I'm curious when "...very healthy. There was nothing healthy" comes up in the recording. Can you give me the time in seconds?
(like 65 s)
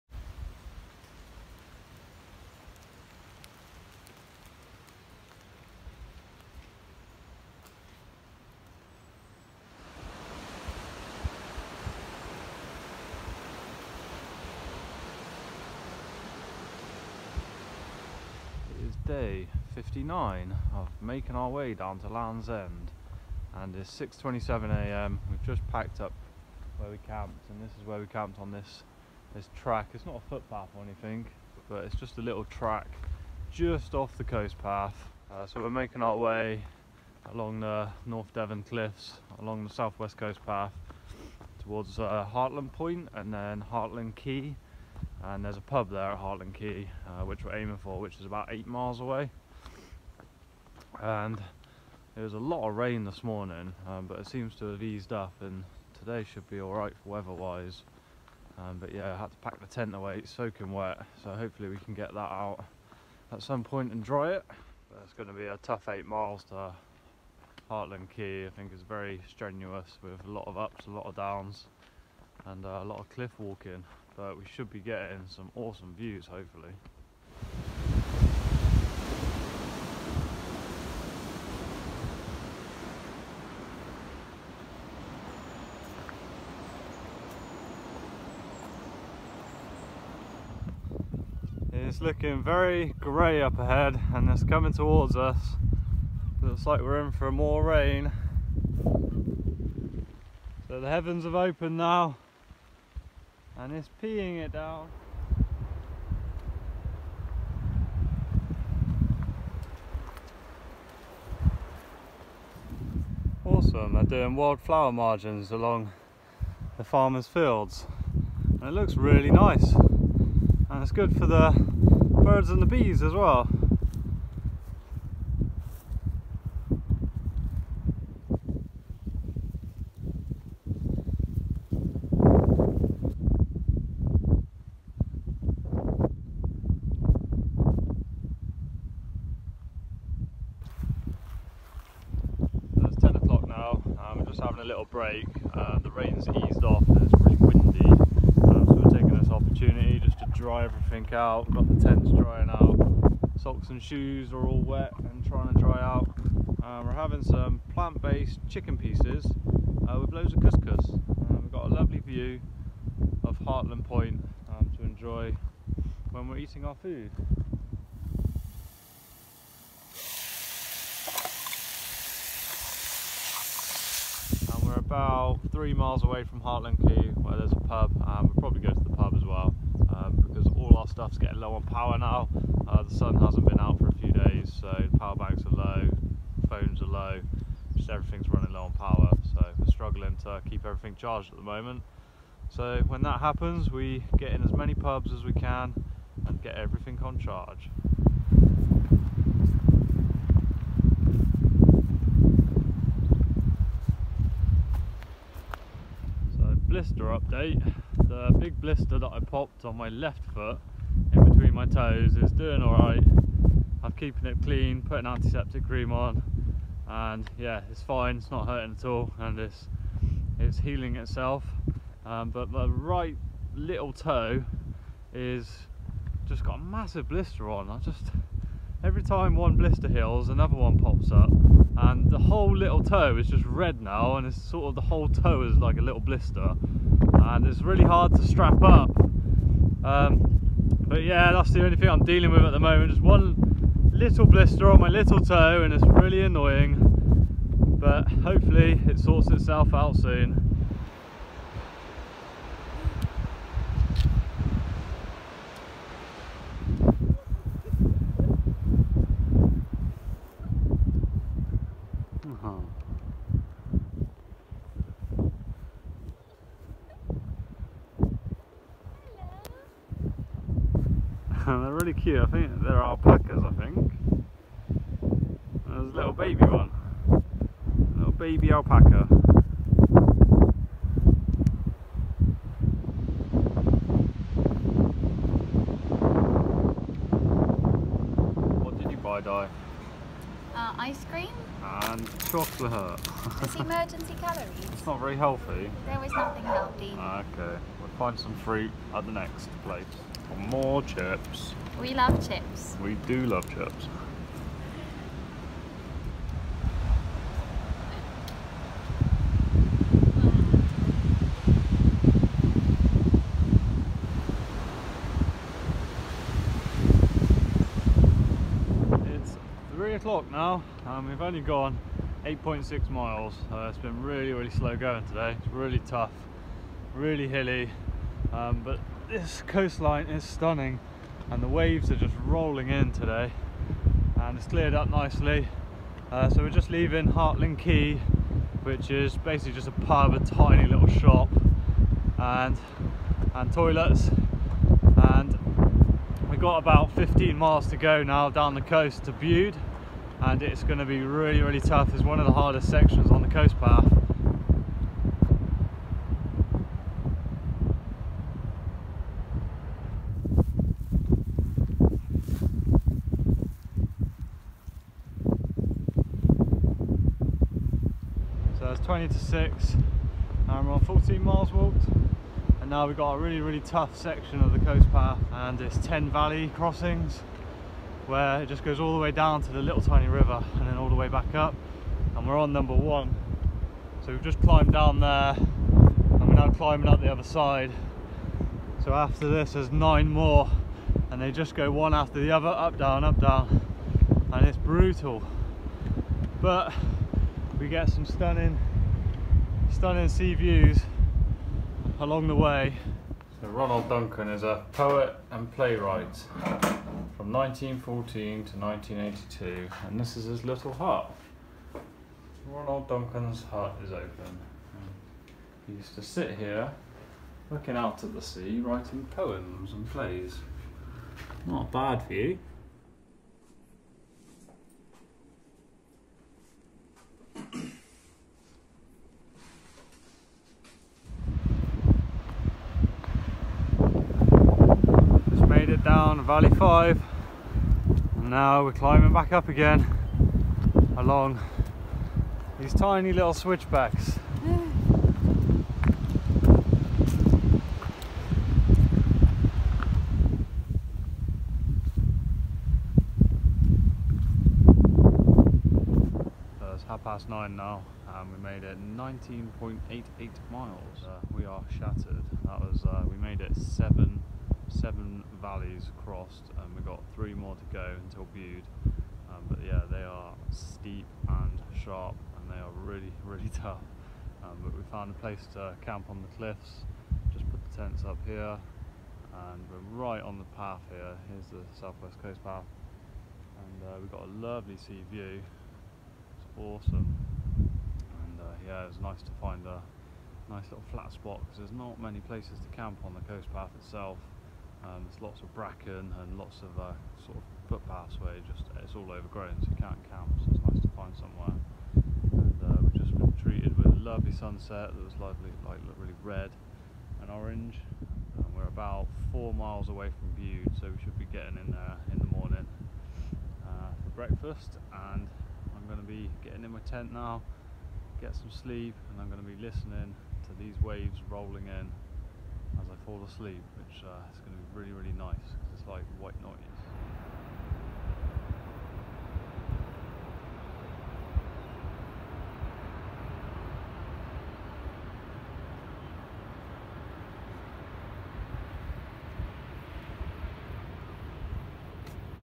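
294 s.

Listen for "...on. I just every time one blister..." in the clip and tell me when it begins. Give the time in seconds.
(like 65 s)
227 s.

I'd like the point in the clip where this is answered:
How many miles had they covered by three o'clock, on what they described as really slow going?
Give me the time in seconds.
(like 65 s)
322 s.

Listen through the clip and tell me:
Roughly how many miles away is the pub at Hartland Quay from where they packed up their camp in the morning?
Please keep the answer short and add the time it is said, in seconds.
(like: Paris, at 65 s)
8, at 48 s.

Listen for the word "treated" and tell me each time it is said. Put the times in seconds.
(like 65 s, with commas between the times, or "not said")
503 s.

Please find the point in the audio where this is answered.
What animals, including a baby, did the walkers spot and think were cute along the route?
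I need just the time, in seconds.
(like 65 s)
272 s.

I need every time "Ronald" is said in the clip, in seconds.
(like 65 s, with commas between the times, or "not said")
403 s, 412 s.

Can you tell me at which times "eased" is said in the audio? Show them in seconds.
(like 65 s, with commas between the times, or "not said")
54 s, 146 s.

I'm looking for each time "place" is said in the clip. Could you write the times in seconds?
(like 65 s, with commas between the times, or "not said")
299 s, 475 s, 492 s.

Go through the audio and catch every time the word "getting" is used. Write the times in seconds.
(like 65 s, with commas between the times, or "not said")
74 s, 181 s, 511 s, 516 s.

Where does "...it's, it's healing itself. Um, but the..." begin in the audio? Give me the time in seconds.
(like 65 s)
219 s.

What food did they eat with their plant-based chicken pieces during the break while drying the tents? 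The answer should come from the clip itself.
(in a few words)
couscous.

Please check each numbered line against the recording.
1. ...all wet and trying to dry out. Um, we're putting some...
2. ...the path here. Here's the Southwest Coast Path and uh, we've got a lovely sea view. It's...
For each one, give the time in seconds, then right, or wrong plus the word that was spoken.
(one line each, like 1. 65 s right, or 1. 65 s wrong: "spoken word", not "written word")
1. 154 s wrong: "having", not "putting"
2. 480 s right.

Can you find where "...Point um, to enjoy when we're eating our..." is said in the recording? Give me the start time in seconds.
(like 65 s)
163 s.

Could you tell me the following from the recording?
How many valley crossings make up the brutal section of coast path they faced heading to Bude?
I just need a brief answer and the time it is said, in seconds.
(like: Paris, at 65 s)
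10, at 375 s.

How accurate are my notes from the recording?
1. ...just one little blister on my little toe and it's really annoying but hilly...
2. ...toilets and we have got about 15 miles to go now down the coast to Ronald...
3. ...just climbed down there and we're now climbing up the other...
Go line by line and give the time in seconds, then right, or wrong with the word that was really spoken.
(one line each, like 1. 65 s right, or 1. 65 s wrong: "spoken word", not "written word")
1. 242 s wrong: "hopefully", not "hilly"
2. 343 s wrong: "Bude", not "Ronald"
3. 384 s right.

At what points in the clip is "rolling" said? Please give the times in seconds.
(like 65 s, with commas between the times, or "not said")
332 s, 521 s.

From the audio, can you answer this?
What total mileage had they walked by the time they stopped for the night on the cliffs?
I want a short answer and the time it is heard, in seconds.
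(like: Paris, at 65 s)
19.88, at 458 s.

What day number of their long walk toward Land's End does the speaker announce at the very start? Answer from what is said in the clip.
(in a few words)
59.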